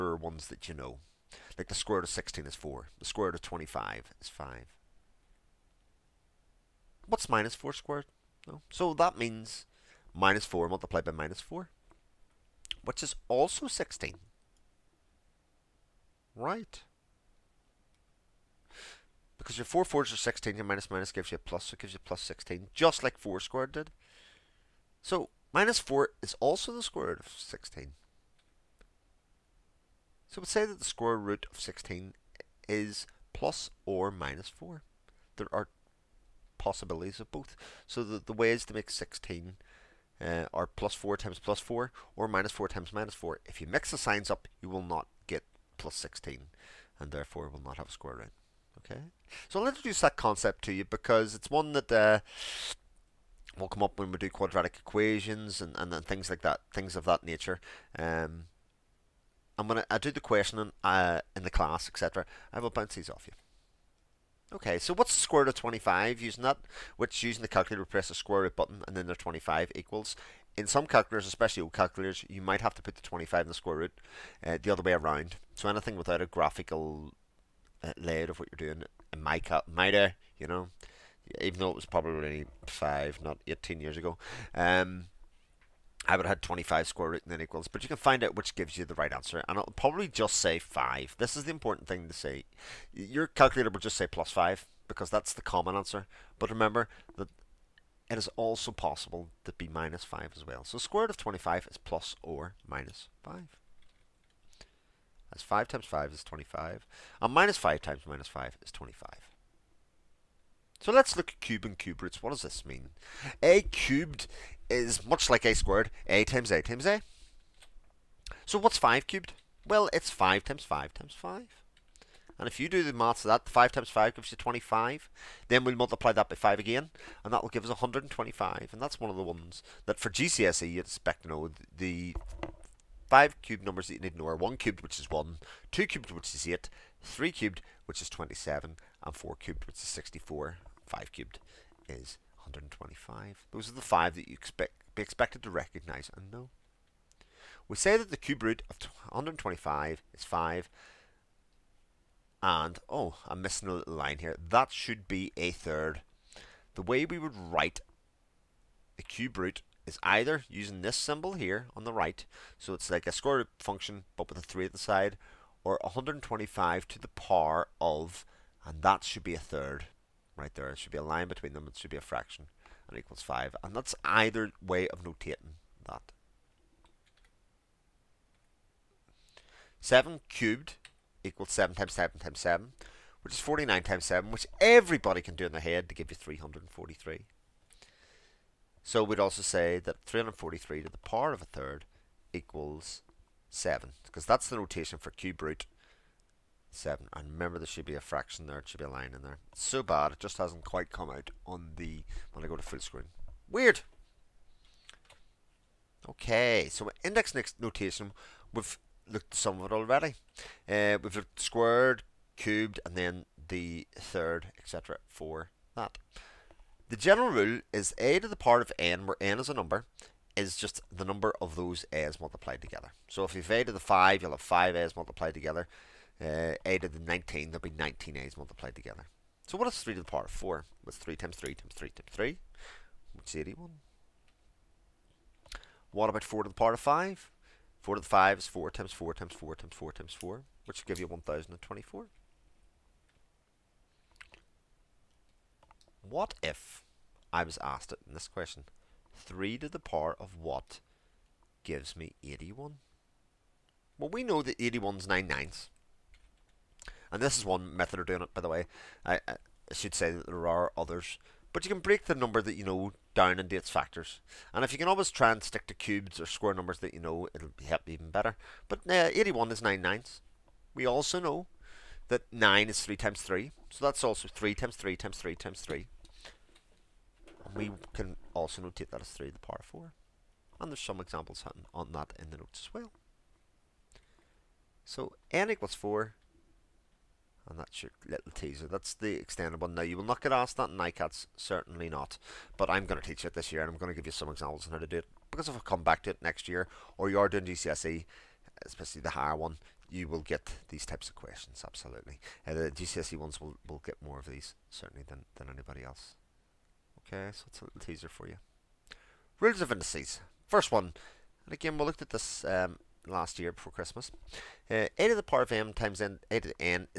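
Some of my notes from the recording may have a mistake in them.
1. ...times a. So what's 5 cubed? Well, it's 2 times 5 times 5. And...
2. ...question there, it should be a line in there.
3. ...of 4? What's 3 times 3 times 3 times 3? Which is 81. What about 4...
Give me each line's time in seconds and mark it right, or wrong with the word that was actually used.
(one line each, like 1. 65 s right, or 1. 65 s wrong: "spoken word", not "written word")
1. 116 s wrong: "5", not "2"
2. 198 s wrong: "fraction", not "question"
3. 230 s right.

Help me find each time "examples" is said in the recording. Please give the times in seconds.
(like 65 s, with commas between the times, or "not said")
280 s, 294 s.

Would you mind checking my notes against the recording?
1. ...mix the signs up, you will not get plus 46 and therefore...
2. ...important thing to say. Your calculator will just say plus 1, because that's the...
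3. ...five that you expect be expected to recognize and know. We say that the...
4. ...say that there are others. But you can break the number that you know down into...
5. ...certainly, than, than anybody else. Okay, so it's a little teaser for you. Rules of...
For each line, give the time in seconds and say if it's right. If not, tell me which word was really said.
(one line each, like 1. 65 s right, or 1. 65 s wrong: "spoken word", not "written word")
1. 43 s wrong: "16", not "46"
2. 91 s wrong: "5", not "1"
3. 143 s right
4. 259 s right
5. 304 s right.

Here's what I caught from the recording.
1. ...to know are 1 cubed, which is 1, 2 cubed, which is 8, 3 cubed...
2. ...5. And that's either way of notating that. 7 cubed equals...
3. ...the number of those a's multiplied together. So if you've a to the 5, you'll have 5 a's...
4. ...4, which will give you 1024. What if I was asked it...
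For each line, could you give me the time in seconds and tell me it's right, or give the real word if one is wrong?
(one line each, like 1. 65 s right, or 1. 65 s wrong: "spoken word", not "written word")
1. 134 s right
2. 173 s right
3. 220 s right
4. 240 s right.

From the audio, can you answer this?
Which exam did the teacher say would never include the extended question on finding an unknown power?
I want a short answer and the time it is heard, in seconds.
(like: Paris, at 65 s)
NICATS, at 290 s.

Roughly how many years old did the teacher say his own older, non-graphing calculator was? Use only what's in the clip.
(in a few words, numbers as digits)
18.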